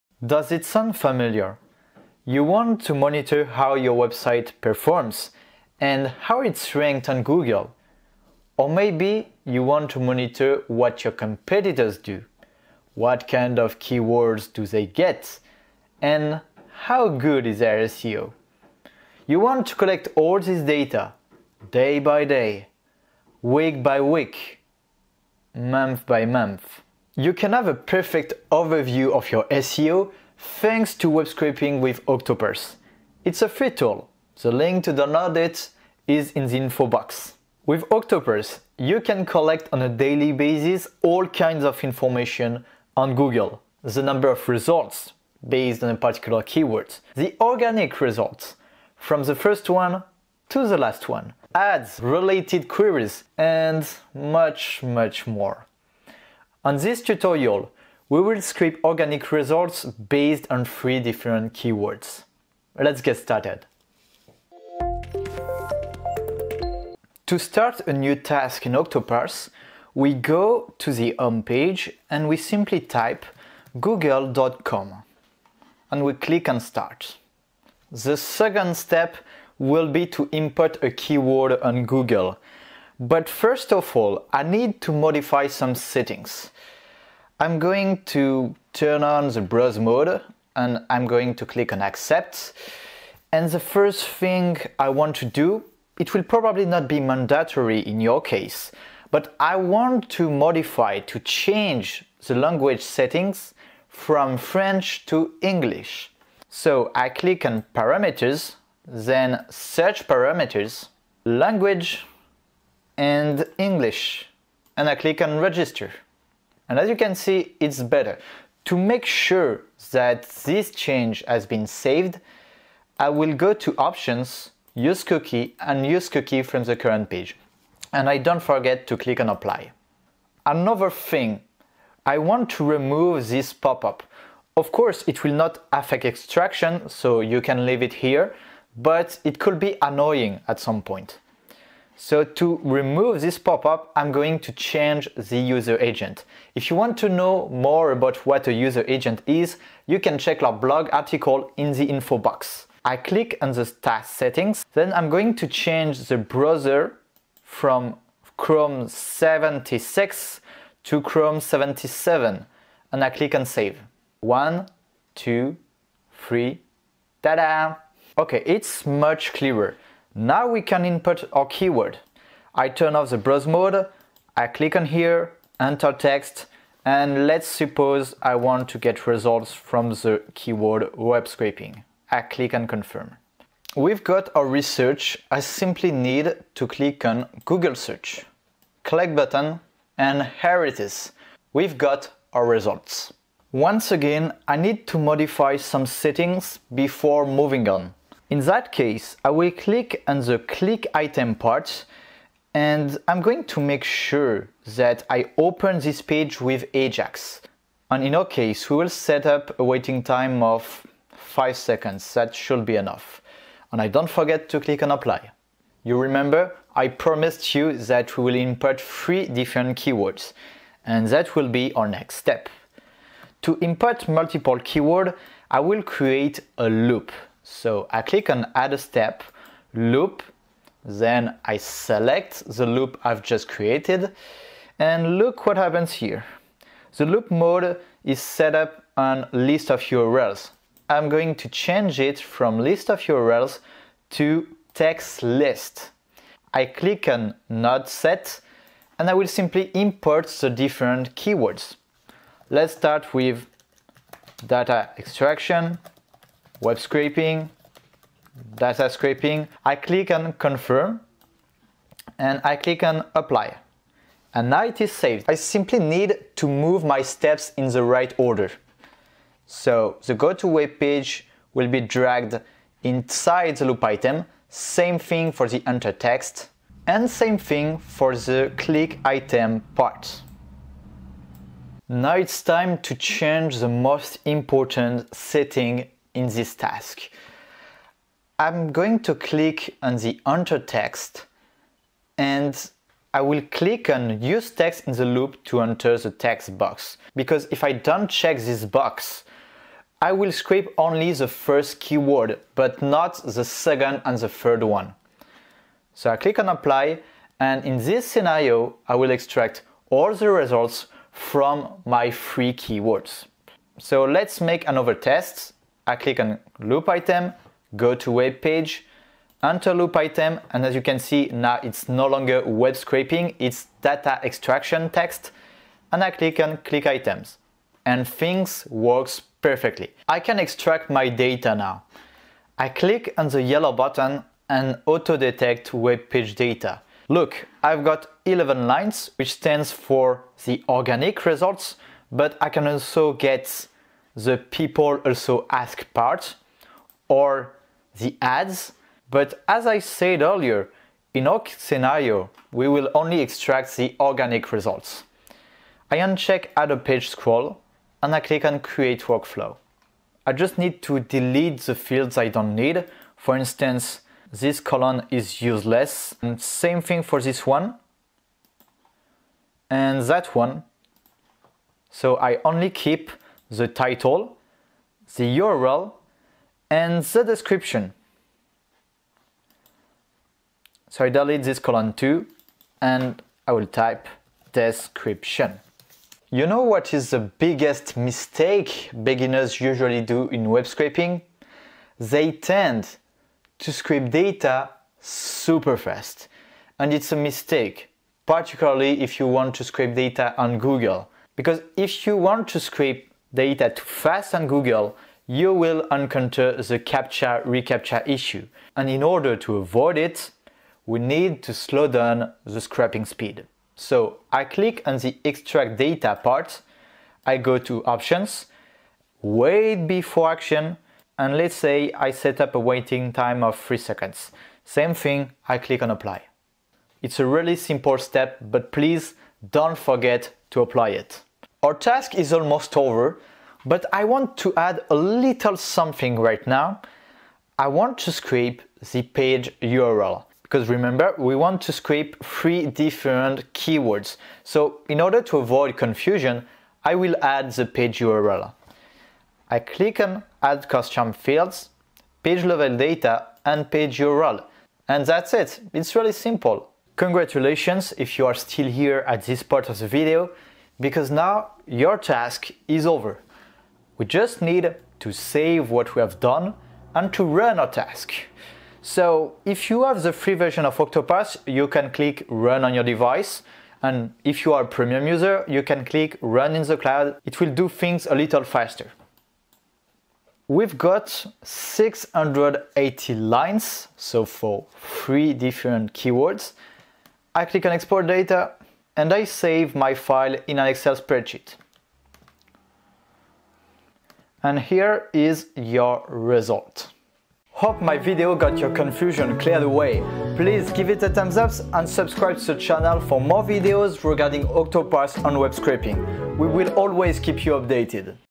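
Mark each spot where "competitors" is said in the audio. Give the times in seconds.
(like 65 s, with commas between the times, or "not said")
11 s.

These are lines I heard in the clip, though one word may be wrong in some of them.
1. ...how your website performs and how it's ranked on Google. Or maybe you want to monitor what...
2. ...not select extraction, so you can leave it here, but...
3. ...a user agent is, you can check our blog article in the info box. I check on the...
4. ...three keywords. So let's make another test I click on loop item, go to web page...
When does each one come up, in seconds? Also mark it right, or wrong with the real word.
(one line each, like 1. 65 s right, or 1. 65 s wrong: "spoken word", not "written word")
1. 3 s right
2. 135 s wrong: "affect", not "select"
3. 148 s wrong: "click", not "check"
4. 312 s right.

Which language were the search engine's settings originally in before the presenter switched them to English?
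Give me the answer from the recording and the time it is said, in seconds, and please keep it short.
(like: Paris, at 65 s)
French, at 104 s.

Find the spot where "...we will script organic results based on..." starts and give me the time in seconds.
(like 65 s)
58 s.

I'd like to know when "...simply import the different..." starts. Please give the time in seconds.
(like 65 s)
249 s.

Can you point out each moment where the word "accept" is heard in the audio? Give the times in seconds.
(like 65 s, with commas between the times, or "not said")
91 s.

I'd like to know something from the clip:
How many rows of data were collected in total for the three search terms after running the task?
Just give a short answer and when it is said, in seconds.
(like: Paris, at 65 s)
680, at 481 s.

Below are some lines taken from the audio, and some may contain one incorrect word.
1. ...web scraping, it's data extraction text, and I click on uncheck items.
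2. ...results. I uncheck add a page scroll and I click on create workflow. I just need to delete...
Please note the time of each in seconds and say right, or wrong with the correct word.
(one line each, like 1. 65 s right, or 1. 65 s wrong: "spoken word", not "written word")
1. 322 s wrong: "click", not "uncheck"
2. 354 s right.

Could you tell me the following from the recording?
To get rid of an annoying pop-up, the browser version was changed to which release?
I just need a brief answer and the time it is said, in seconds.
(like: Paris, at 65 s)
Chrome 77, at 161 s.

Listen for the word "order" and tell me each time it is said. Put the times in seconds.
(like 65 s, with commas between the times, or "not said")
268 s, 409 s, 444 s.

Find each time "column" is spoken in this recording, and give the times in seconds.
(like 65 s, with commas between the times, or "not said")
364 s, 381 s.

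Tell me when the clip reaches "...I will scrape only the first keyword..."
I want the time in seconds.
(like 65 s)
300 s.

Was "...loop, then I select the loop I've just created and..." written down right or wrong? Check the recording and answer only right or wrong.
right.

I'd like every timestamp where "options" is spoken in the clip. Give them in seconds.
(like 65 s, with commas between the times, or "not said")
123 s, 417 s.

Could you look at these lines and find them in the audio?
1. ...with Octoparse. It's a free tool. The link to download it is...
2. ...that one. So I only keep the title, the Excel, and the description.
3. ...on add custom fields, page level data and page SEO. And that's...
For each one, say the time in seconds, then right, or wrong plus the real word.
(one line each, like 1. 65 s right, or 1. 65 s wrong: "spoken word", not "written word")
1. 31 s right
2. 370 s wrong: "URL", not "Excel"
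3. 449 s wrong: "URL", not "SEO".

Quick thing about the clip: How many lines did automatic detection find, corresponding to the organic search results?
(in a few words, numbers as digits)
11.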